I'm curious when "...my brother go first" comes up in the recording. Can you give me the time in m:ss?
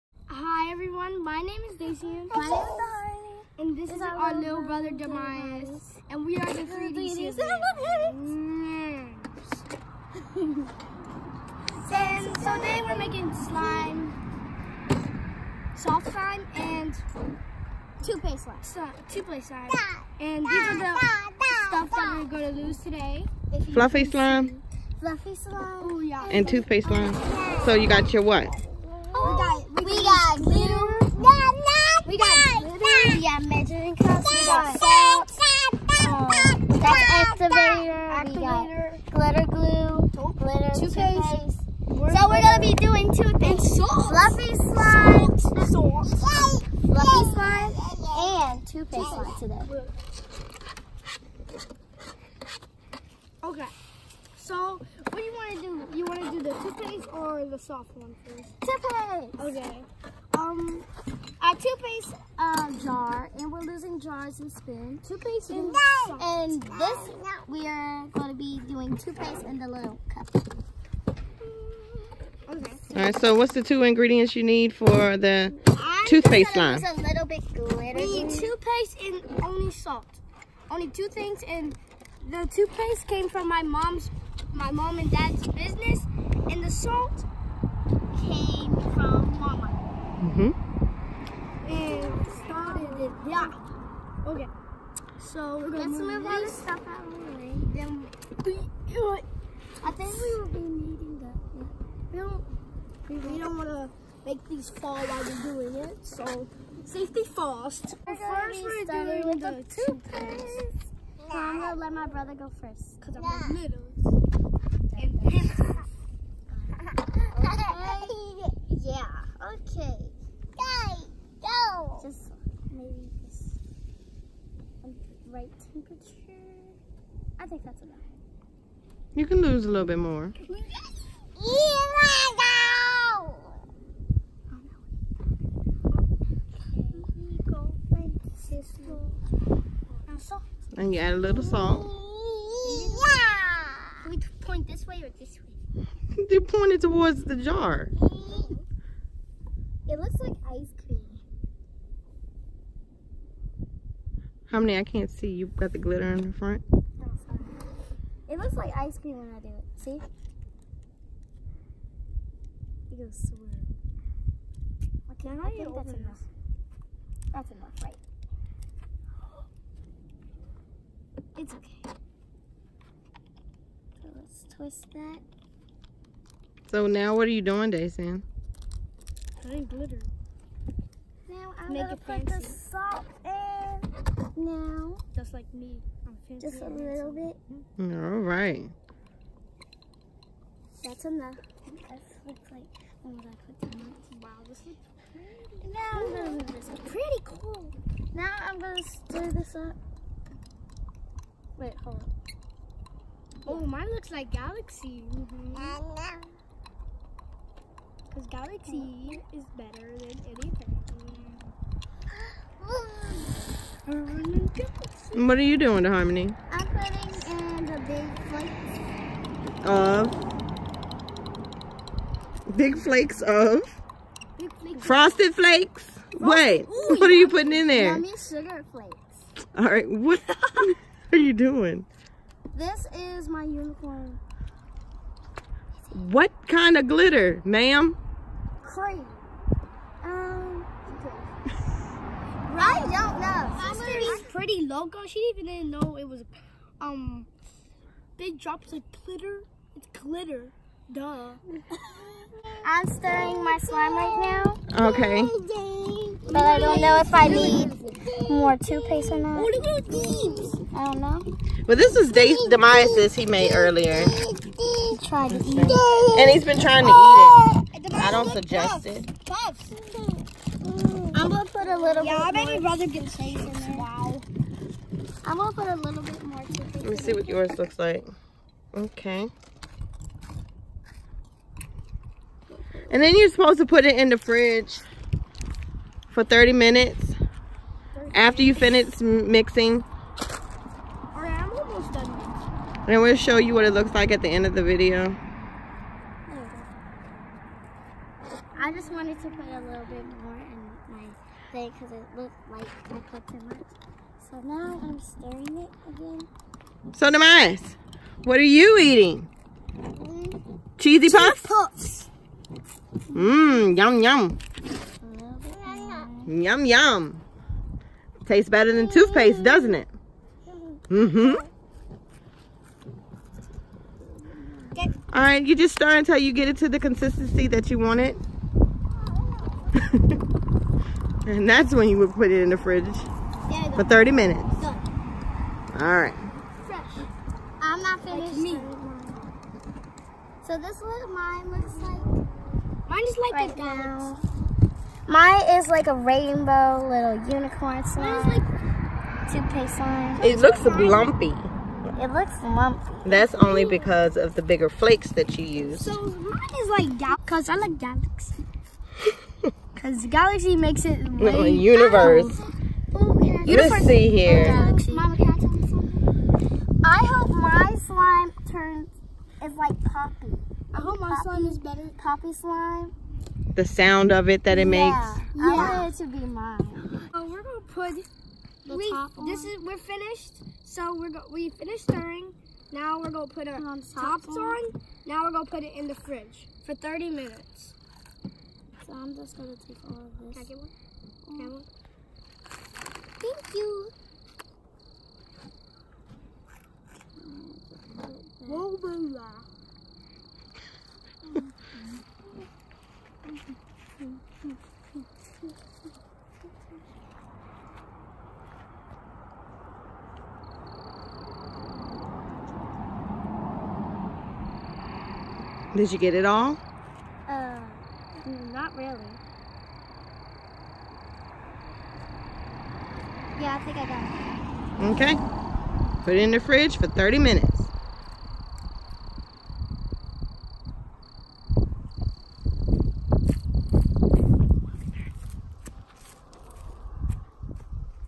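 1:51.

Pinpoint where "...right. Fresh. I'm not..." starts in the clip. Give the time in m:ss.
5:36.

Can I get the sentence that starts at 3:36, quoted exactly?
I'm putting in the big flakes.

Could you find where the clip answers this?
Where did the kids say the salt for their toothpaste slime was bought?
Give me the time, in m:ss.
1:29.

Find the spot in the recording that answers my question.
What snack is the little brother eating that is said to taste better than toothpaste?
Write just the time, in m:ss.
5:10.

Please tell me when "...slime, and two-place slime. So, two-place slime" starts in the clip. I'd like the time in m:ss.
0:16.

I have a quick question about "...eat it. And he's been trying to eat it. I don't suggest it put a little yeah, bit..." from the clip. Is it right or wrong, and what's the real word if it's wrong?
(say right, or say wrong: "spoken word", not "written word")
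right.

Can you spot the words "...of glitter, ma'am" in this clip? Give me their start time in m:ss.
3:56.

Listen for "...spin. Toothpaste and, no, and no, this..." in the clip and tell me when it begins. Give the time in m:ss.
1:04.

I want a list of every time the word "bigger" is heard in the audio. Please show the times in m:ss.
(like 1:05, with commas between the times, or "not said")
5:54.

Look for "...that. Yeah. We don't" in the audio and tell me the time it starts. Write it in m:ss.
1:41.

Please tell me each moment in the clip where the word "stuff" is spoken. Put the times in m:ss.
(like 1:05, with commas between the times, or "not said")
0:21, 1:36.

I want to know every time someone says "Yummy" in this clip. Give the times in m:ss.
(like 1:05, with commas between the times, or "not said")
3:47.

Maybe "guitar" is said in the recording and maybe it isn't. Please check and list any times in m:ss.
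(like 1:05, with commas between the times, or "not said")
not said.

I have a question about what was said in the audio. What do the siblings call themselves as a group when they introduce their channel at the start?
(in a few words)
the 3D siblings.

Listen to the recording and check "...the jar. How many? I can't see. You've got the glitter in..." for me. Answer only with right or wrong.
right.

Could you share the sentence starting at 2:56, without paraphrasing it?
So now what are you doing, Dayson?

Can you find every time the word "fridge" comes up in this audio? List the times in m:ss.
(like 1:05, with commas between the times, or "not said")
4:44, 5:32, 6:25, 7:06.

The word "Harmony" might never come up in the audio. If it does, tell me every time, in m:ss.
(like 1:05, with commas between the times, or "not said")
3:35.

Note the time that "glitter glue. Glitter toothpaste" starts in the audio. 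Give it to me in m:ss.
0:39.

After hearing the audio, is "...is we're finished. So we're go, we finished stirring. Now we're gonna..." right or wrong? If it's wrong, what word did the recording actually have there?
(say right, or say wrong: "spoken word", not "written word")
right.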